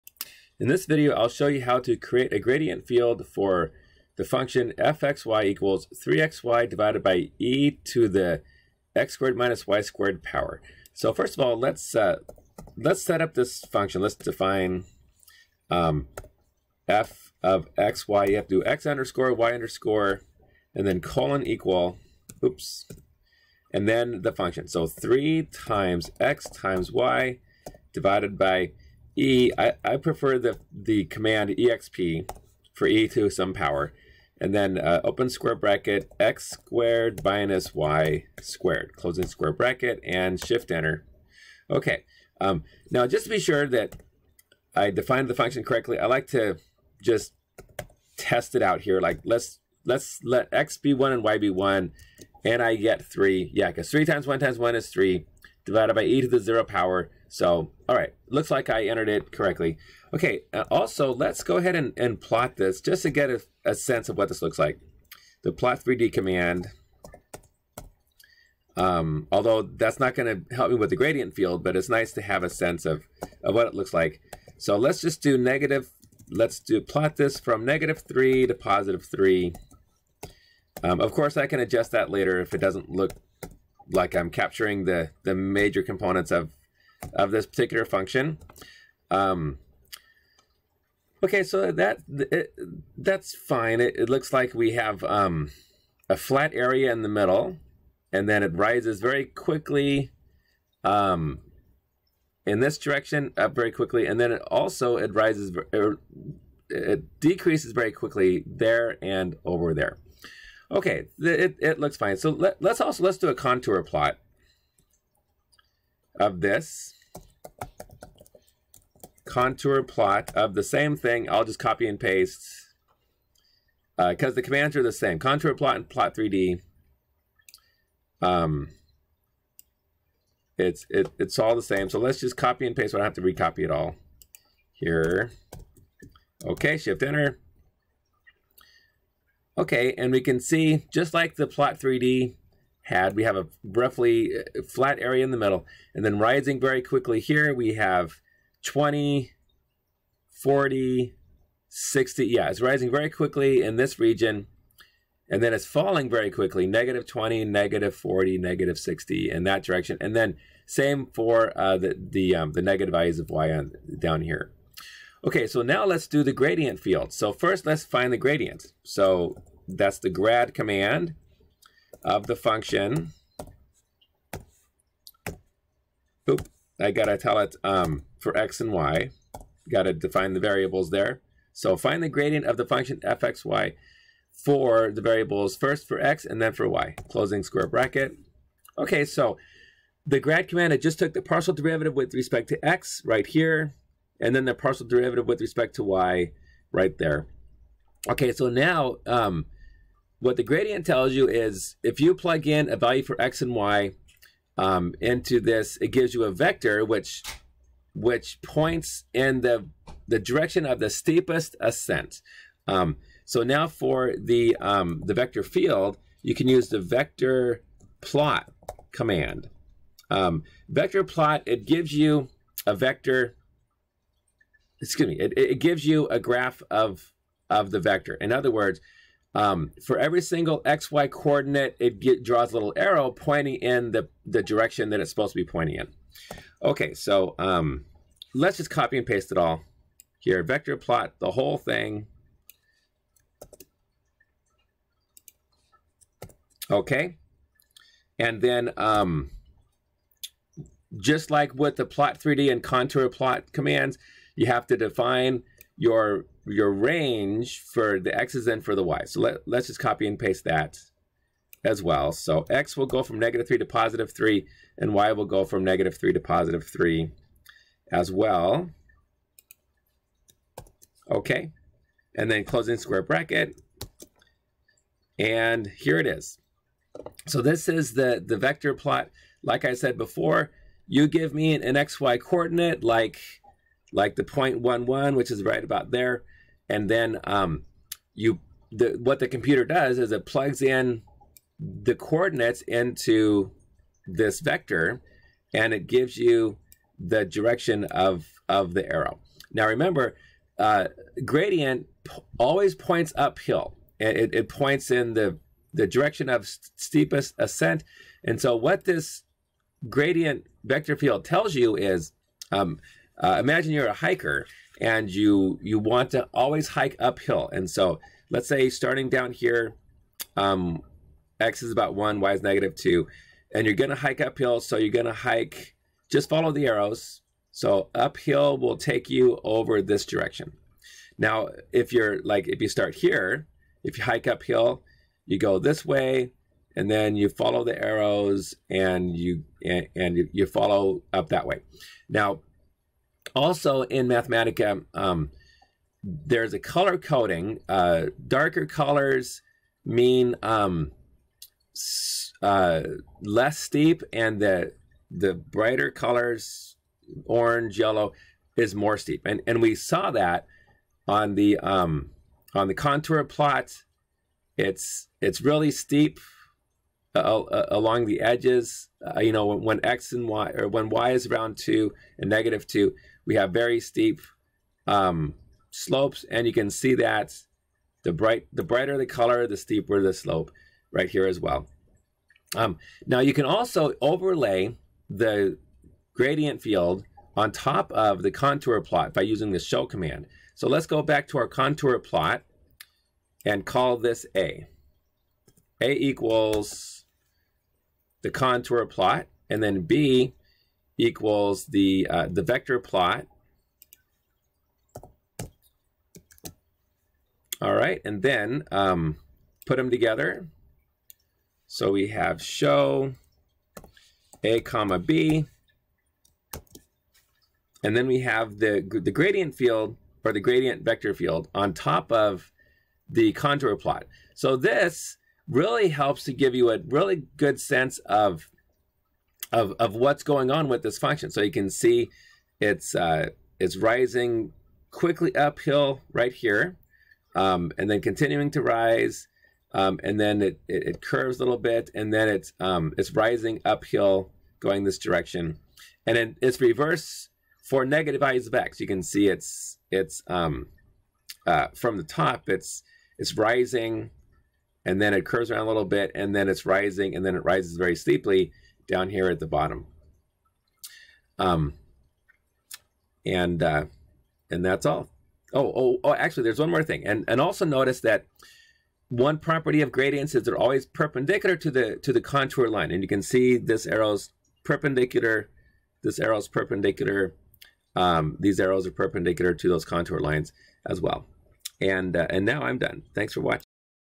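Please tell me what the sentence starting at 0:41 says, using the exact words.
Okay, um, now just to be sure that I defined the function correctly, I like to just test it out here.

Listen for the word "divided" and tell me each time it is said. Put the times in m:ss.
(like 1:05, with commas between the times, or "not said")
0:06, 0:27, 0:55.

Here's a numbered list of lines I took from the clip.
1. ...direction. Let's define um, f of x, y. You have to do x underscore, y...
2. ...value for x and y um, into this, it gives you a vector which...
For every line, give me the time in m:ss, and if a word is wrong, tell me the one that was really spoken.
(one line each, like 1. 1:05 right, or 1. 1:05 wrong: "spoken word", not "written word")
1. 0:13 wrong: "function", not "direction"
2. 3:22 right.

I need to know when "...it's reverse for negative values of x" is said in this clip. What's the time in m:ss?
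7:26.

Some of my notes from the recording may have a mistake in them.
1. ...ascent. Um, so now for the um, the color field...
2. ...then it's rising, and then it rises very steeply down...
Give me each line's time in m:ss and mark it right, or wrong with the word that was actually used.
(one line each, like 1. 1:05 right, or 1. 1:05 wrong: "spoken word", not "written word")
1. 3:31 wrong: "vector", not "color"
2. 7:36 right.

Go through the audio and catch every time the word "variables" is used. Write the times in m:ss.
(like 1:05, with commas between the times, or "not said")
3:00, 3:05.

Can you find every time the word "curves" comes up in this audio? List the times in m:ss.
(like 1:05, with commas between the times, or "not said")
7:21, 7:35.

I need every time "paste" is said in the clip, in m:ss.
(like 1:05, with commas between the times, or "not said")
2:01, 2:12, 3:59, 4:20.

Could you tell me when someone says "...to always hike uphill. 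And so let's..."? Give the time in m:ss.
5:16.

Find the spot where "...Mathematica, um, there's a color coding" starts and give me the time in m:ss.
5:44.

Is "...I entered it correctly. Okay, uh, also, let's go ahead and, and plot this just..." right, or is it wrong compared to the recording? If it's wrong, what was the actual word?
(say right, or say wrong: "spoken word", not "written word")
right.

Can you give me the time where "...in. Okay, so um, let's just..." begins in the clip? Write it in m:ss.
3:55.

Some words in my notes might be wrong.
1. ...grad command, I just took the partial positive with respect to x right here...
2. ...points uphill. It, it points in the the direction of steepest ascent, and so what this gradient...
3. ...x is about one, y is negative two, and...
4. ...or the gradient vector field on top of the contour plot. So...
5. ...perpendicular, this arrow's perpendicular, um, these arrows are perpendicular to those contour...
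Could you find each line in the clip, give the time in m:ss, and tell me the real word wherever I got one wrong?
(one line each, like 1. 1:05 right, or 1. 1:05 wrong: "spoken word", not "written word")
1. 3:10 wrong: "derivative", not "positive"
2. 5:02 right
3. 5:21 right
4. 7:00 right
5. 7:54 right.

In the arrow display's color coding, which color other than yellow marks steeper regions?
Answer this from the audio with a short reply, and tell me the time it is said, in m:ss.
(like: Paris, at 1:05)
orange, at 5:57.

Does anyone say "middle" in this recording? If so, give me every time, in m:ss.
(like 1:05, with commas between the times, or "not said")
1:37, 2:25.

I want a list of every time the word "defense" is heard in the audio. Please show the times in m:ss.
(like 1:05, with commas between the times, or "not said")
not said.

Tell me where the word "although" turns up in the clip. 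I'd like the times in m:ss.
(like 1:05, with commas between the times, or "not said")
1:09.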